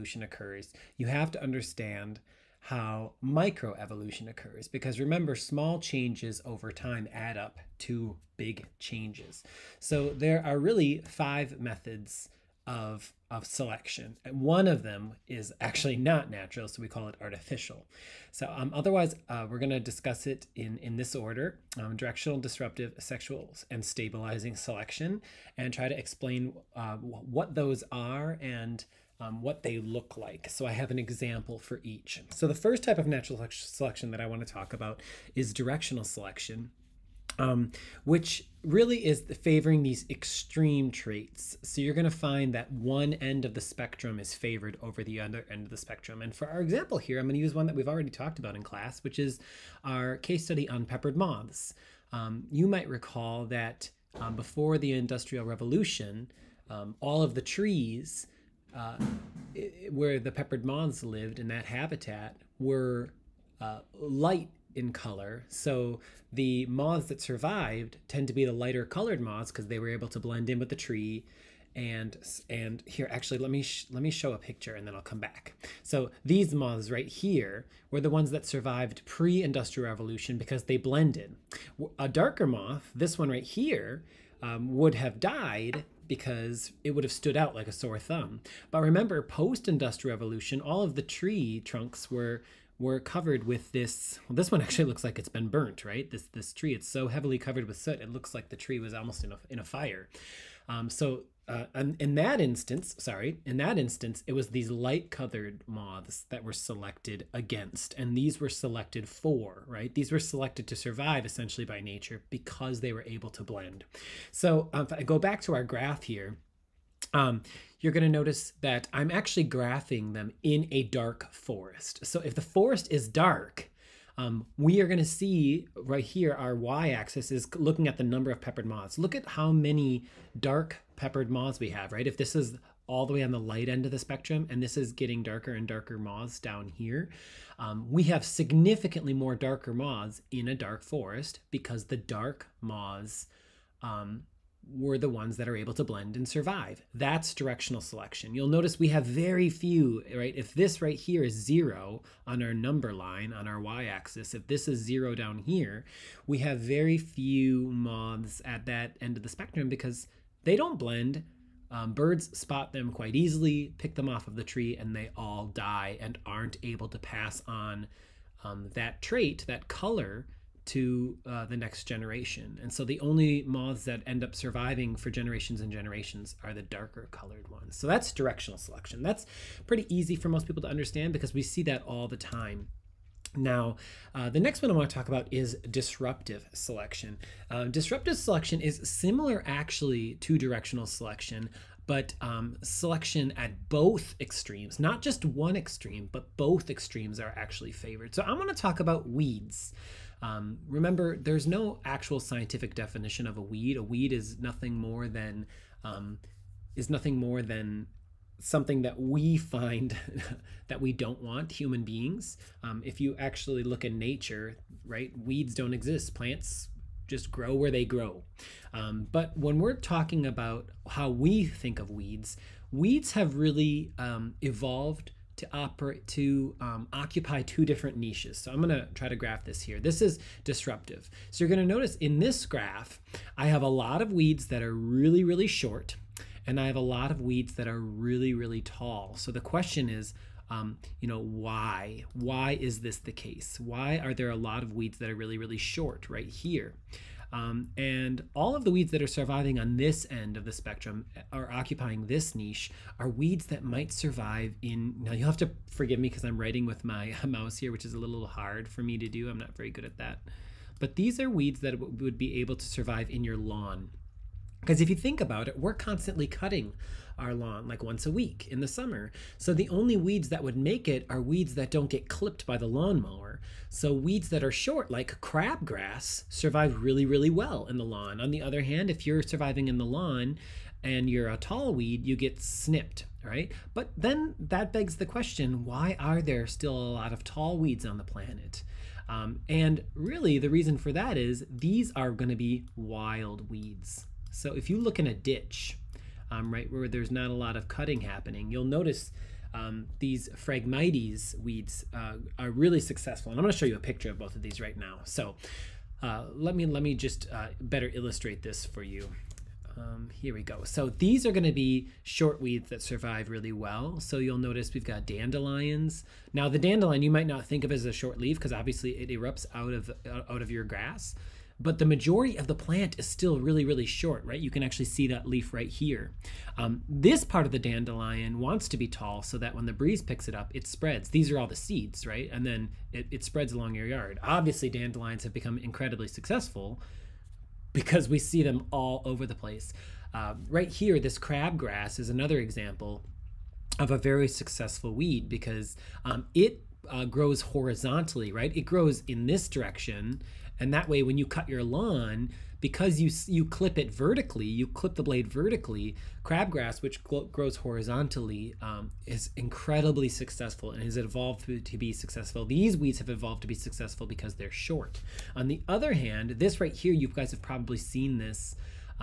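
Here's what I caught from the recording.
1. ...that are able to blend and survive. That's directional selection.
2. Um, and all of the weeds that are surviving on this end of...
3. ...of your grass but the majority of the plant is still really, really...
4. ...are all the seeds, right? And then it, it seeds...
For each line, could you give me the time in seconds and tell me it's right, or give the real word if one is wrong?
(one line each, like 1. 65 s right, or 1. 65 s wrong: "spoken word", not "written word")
1. 145 s right
2. 247 s right
3. 320 s right
4. 331 s wrong: "spreads", not "seeds".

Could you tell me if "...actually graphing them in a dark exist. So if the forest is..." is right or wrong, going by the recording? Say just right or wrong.
wrong.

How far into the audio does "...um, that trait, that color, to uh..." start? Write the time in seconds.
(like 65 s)
168 s.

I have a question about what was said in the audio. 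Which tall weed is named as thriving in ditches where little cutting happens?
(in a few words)
Phragmites.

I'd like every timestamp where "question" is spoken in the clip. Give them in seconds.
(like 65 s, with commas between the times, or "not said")
239 s, 285 s.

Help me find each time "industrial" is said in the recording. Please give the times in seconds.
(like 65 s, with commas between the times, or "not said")
54 s, 79 s, 89 s.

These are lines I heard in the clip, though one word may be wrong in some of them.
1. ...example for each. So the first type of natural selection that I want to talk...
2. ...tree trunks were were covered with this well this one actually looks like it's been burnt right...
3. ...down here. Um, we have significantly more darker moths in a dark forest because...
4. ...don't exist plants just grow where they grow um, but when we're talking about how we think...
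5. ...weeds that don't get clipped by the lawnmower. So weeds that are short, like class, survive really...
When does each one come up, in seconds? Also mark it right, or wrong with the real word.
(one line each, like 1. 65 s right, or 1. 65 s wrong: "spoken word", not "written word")
1. 30 s right
2. 91 s right
3. 136 s right
4. 215 s right
5. 271 s wrong: "crabgrass", not "class".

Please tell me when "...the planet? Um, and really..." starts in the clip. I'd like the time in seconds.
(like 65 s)
287 s.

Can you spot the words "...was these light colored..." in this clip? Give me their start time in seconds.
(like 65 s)
104 s.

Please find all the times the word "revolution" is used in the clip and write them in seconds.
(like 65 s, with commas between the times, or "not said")
55 s, 79 s, 90 s.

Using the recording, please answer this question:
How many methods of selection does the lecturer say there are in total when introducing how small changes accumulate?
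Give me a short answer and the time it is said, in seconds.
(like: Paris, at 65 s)
5, at 11 s.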